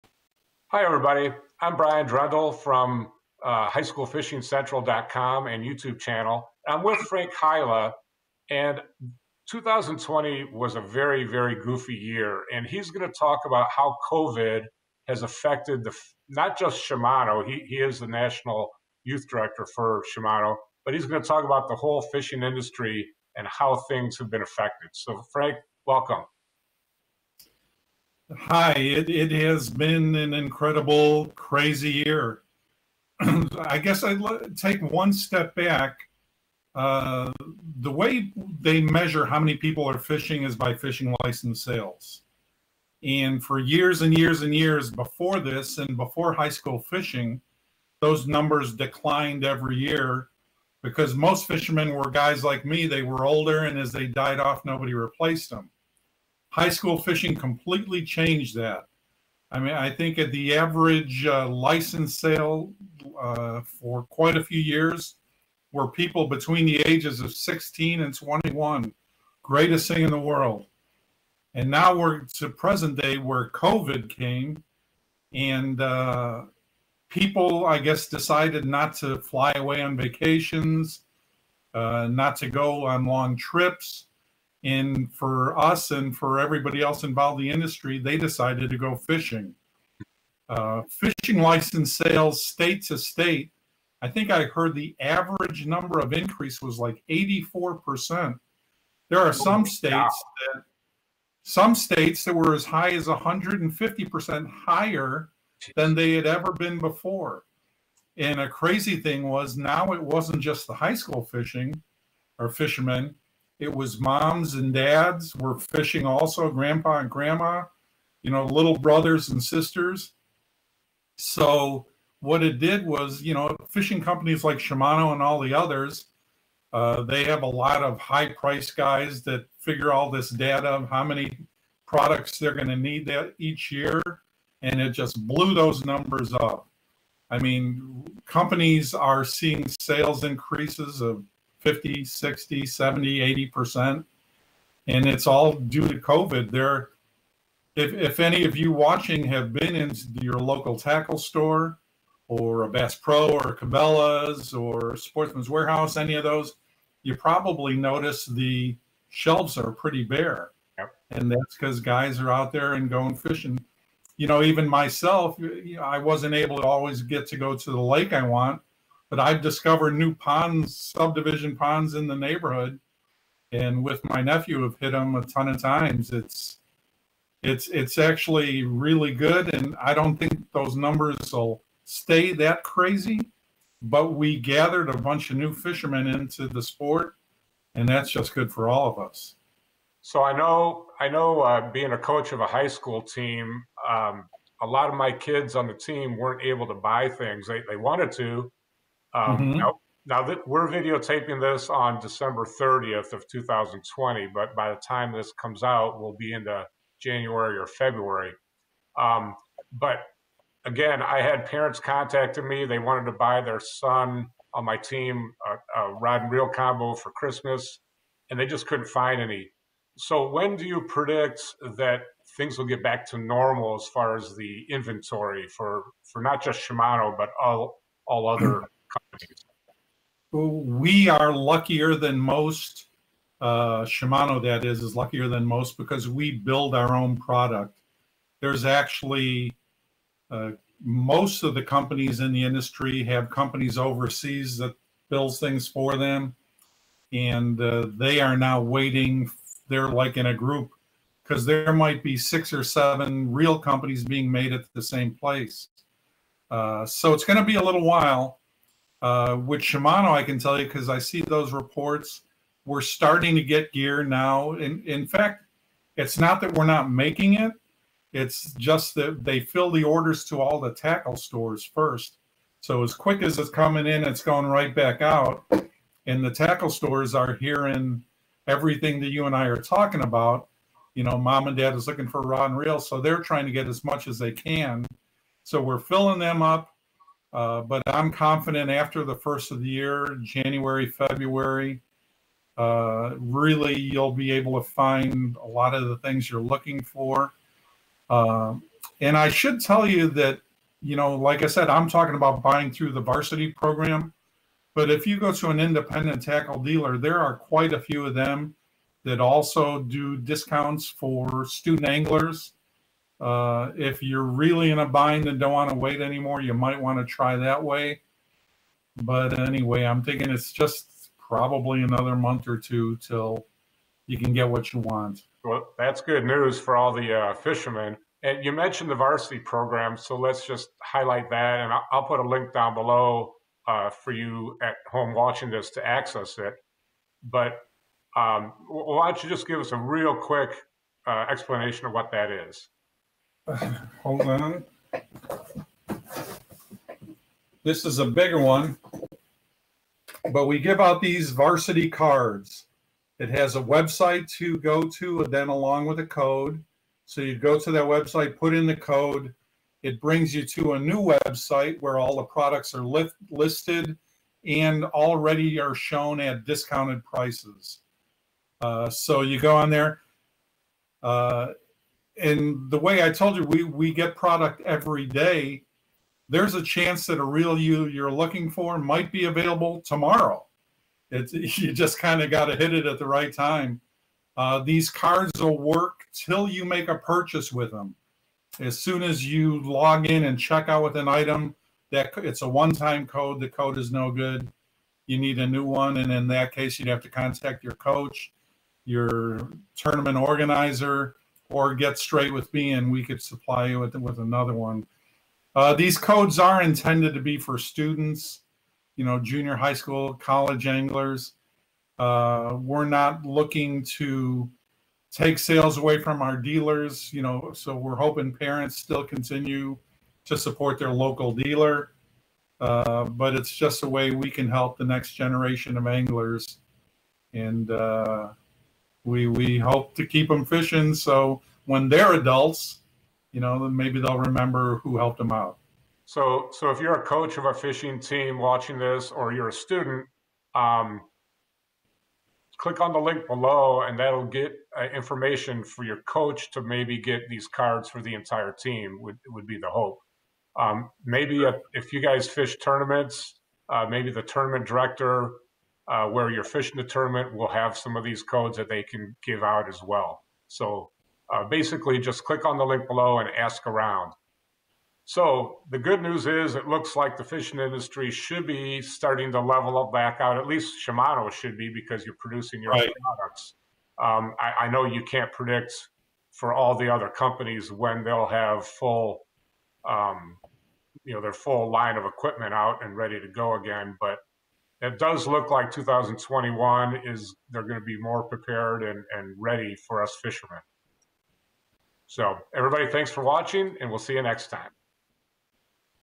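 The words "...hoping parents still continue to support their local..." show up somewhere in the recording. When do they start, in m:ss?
6:57.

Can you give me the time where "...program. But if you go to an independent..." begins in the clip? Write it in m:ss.
5:03.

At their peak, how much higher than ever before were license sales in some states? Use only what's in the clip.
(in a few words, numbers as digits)
150%.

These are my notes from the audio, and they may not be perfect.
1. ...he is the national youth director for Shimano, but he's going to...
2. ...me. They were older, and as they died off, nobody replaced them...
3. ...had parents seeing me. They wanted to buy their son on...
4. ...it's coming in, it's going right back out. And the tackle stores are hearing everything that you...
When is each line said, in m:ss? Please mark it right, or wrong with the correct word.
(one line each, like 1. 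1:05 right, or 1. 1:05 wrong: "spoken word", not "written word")
1. 0:17 right
2. 0:52 right
3. 3:31 wrong: "contacting", not "seeing"
4. 4:33 right.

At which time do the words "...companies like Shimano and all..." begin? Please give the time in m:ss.
2:04.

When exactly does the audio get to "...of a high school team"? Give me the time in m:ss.
3:12.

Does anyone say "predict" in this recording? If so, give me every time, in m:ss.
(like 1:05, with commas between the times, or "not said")
3:40, 7:55.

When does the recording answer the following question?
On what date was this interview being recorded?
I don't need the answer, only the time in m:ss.
3:21.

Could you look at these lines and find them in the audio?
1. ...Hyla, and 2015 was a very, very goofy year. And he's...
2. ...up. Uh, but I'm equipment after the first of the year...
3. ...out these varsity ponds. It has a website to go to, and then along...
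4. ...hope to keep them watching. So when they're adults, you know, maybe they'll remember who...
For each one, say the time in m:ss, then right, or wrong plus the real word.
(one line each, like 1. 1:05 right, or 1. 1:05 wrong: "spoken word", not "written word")
1. 0:07 wrong: "2020", not "2015"
2. 4:46 wrong: "confident", not "equipment"
3. 5:50 wrong: "cards", not "ponds"
4. 7:09 wrong: "fishing", not "watching".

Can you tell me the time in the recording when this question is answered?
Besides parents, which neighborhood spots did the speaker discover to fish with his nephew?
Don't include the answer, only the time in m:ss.
2:50.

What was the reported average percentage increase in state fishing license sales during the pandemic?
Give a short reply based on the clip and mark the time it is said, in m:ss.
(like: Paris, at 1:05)
84%, at 1:37.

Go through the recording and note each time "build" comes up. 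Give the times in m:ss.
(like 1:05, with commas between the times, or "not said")
3:56, 4:05.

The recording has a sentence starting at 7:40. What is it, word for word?
So uh, basically, just click on the link below and ask around.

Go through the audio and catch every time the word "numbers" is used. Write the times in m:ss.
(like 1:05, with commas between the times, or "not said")
0:48, 1:35, 2:15, 3:00.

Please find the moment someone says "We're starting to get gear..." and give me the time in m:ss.
4:22.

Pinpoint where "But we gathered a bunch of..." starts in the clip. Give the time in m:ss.
3:03.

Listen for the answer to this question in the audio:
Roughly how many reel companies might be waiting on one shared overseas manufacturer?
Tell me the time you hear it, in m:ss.
4:12.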